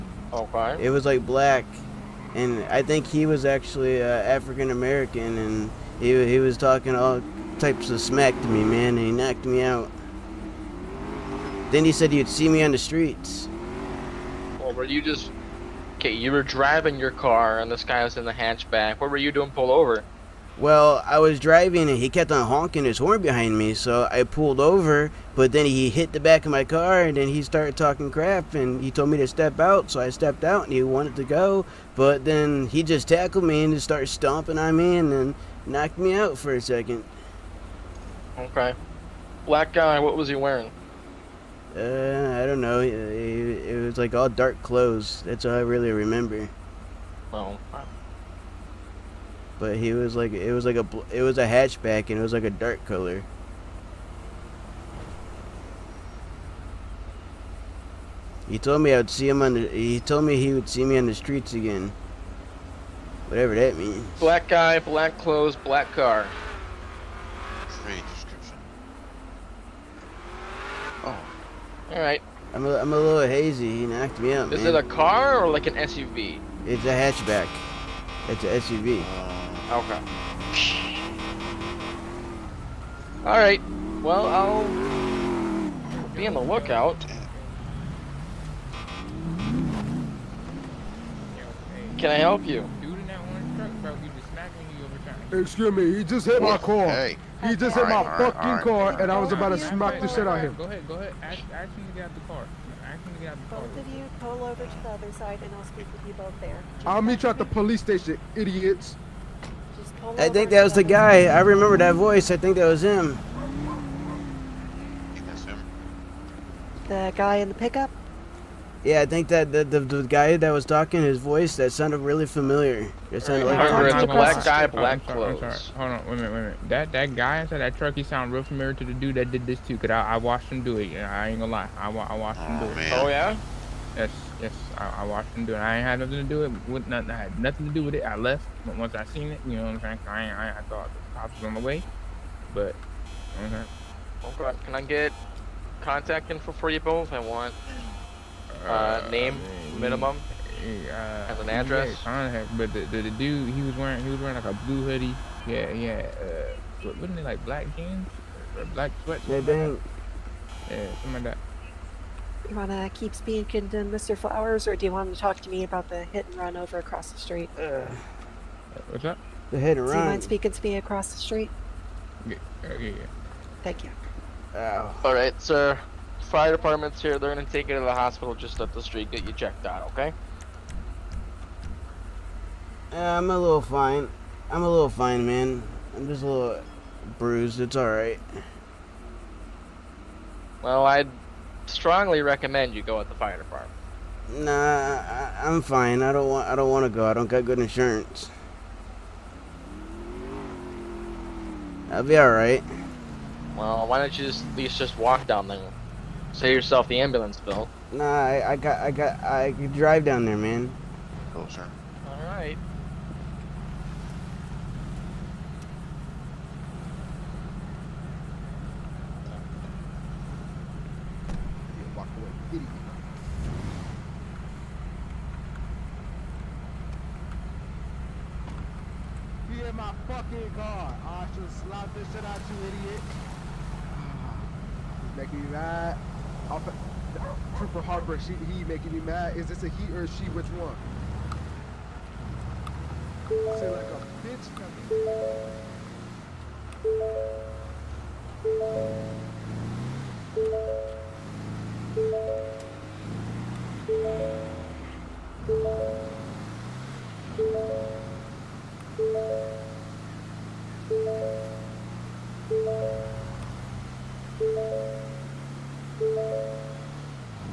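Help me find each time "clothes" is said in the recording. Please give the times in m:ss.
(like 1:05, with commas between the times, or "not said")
0:44, 1:05, 2:05.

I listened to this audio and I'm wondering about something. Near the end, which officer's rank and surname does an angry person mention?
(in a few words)
Trooper Harper.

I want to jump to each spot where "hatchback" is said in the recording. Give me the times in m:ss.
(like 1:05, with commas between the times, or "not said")
0:18, 0:51, 1:16.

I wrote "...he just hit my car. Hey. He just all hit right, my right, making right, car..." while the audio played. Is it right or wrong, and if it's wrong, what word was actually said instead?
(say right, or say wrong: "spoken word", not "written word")
wrong: "fucking", not "making".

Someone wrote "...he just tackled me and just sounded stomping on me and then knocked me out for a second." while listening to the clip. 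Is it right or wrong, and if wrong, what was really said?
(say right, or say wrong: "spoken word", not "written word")
wrong: "started", not "sounded".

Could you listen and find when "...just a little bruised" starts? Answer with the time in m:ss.
3:06.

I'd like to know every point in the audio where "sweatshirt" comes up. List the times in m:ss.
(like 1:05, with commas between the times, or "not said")
2:39.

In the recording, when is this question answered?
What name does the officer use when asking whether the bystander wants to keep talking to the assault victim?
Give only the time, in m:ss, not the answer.
2:43.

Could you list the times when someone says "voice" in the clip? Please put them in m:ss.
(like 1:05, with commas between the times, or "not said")
1:51, 2:01.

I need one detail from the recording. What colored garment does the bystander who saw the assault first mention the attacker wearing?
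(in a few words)
Blue hoodie.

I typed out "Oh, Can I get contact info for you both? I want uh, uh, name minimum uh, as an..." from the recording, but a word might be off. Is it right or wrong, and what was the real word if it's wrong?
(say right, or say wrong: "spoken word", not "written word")
right.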